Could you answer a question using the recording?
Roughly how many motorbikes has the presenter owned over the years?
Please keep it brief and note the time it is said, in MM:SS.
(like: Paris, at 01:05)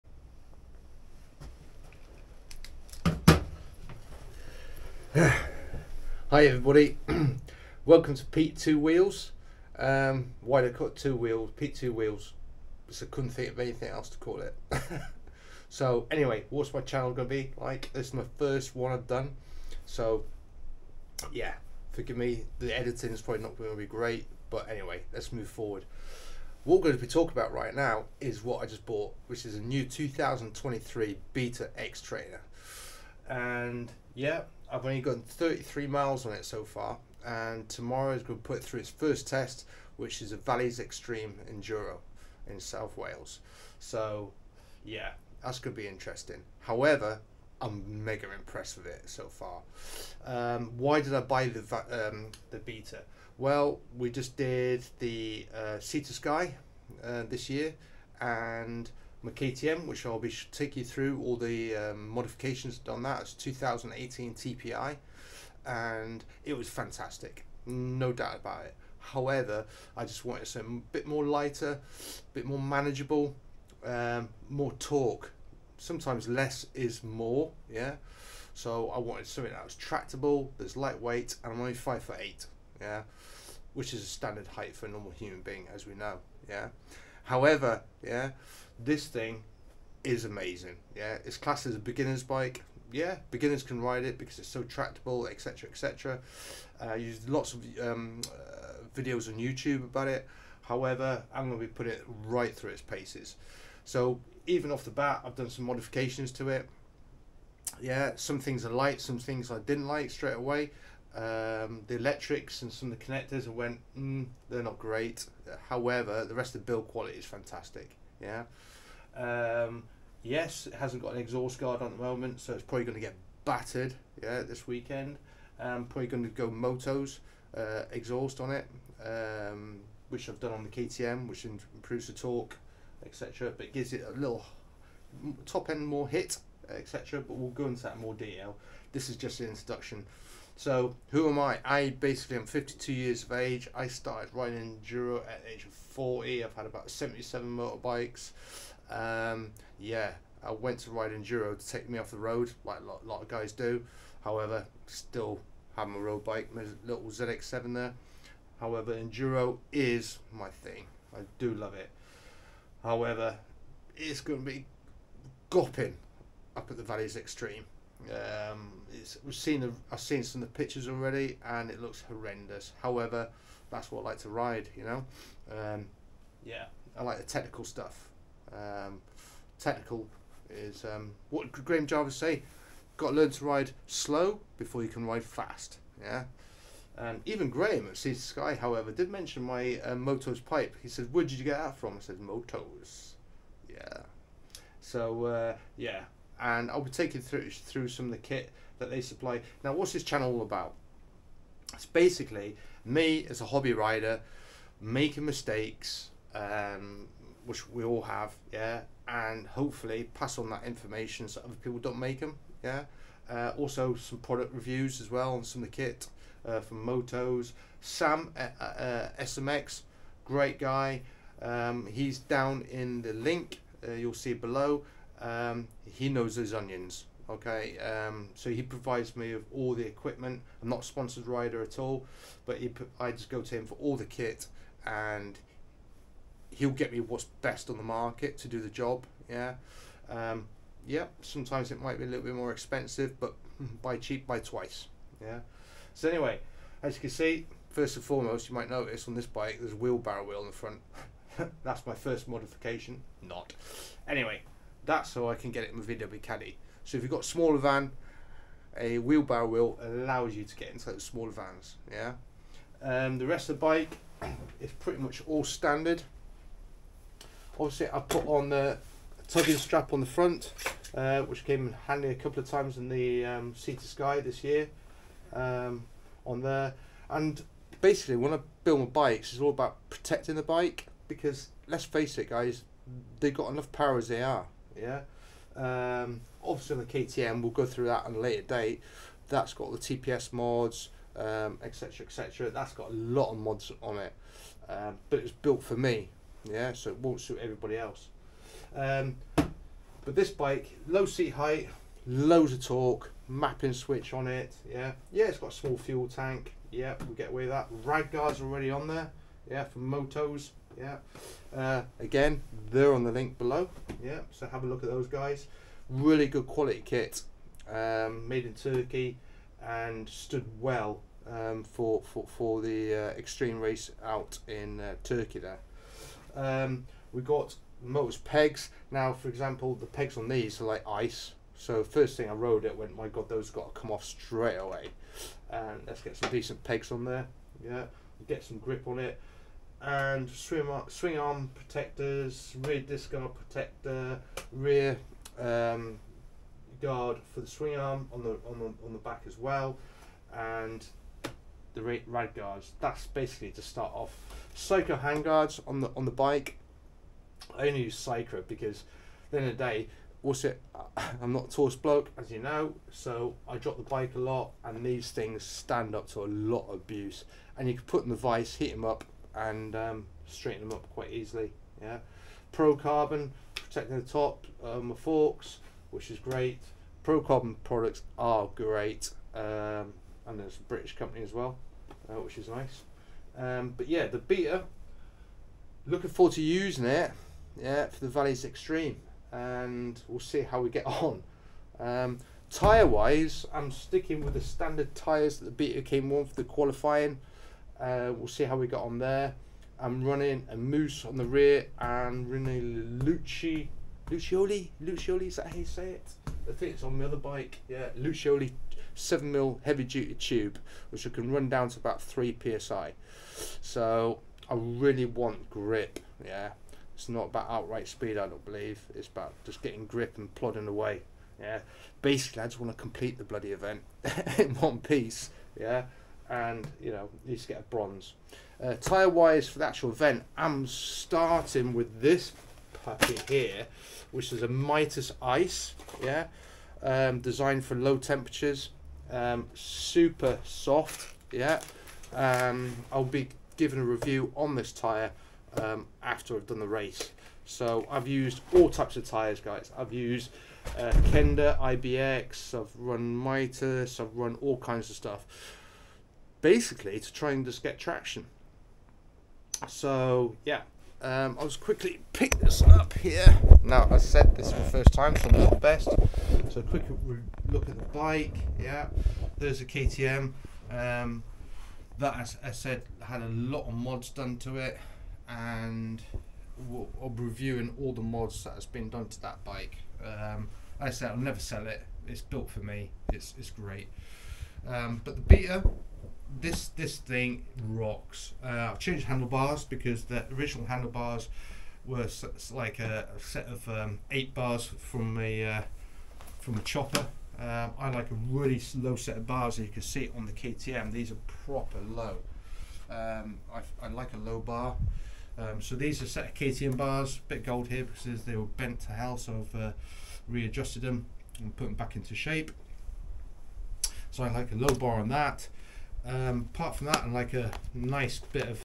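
77, at 02:26.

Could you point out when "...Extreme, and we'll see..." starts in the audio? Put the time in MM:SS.
06:28.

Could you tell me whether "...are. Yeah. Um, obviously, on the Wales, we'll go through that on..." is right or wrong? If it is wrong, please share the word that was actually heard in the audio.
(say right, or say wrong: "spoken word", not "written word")
wrong: "KTM", not "Wales".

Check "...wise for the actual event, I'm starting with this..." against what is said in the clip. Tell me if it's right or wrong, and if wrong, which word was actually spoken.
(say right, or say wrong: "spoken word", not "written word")
right.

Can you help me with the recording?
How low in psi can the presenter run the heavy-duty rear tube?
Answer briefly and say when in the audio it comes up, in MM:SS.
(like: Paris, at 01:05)
3 psi, at 06:52.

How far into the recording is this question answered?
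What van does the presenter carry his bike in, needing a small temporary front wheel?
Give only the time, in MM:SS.
04:15.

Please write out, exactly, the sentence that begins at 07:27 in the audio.
So I've used all types of tires, guys.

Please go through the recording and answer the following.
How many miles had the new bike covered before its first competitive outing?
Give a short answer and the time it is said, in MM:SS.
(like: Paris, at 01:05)
33, at 00:35.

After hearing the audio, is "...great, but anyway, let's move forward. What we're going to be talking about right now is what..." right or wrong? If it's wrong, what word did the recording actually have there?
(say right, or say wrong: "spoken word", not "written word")
right.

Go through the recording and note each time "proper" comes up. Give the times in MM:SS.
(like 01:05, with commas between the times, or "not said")
08:21.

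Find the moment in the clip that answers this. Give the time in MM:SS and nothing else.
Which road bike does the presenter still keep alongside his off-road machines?
02:37.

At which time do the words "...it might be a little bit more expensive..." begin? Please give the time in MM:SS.
04:01.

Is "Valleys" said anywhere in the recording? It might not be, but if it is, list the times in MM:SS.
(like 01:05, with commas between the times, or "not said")
00:40, 02:46, 06:28.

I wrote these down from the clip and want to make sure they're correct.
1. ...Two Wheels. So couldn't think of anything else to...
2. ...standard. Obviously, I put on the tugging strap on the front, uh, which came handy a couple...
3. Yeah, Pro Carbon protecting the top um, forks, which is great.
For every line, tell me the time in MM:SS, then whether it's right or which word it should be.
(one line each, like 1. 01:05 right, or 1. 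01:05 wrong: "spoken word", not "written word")
1. 00:11 right
2. 04:25 right
3. 06:11 right.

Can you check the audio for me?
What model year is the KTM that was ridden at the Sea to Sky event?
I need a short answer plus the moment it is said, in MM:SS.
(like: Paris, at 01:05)
2018, at 01:03.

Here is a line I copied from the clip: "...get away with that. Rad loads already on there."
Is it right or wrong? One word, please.
wrong.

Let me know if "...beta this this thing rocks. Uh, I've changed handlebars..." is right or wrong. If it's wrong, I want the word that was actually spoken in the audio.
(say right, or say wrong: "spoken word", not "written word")
right.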